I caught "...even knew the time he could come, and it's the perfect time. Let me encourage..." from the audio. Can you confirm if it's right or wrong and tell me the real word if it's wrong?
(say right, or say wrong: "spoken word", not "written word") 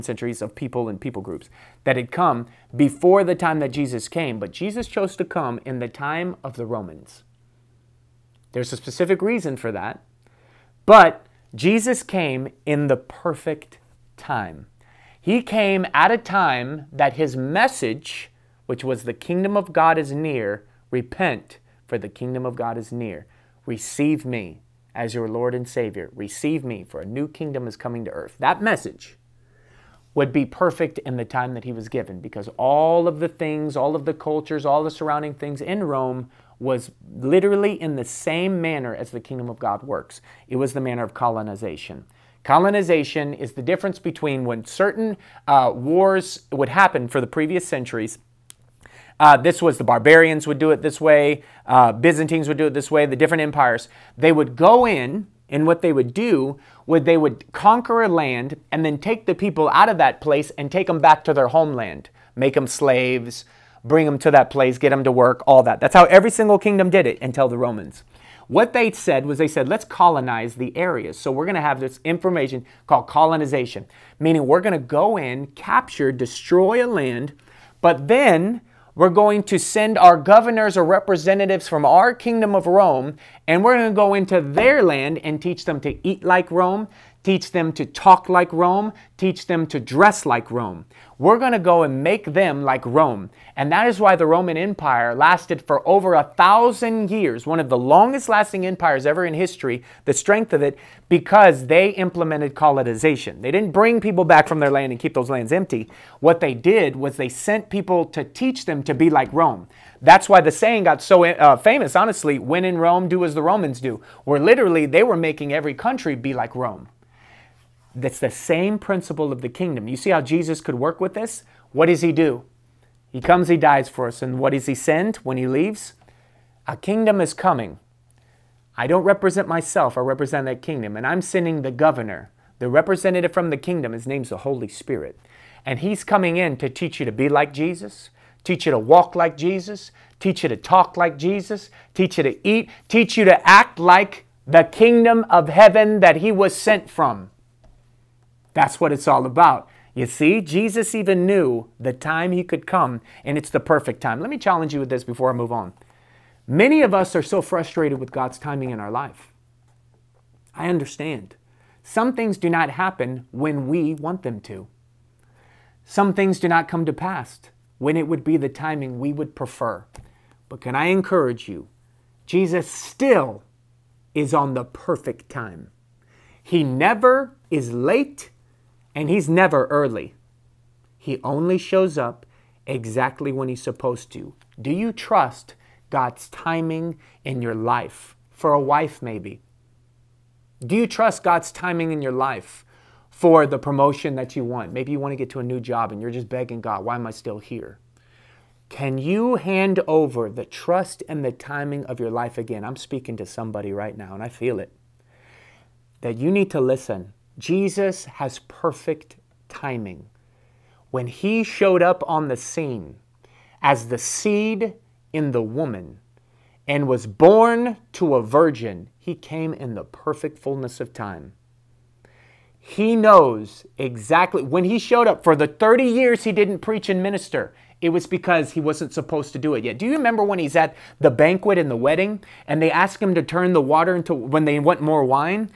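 wrong: "challenge", not "encourage".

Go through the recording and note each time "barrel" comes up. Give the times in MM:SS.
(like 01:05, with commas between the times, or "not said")
not said.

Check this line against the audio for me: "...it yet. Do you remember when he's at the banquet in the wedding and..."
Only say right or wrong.
right.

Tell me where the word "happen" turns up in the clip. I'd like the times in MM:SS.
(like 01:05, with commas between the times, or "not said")
00:46, 02:42.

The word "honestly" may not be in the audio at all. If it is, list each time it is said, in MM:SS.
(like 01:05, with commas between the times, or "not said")
01:51.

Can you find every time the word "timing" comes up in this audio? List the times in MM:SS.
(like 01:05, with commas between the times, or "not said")
02:38, 02:48, 03:06, 03:11, 03:21, 03:29.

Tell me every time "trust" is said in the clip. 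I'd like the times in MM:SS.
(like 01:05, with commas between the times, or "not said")
03:04, 03:10, 03:20.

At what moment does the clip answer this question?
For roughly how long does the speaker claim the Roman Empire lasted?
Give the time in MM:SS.
01:35.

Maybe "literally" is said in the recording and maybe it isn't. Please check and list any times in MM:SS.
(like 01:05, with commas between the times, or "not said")
00:37, 01:54.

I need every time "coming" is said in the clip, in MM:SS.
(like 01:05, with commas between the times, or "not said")
00:27, 02:07, 02:16.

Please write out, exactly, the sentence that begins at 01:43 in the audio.
They didn't bring people back from their land and keep those lands empty.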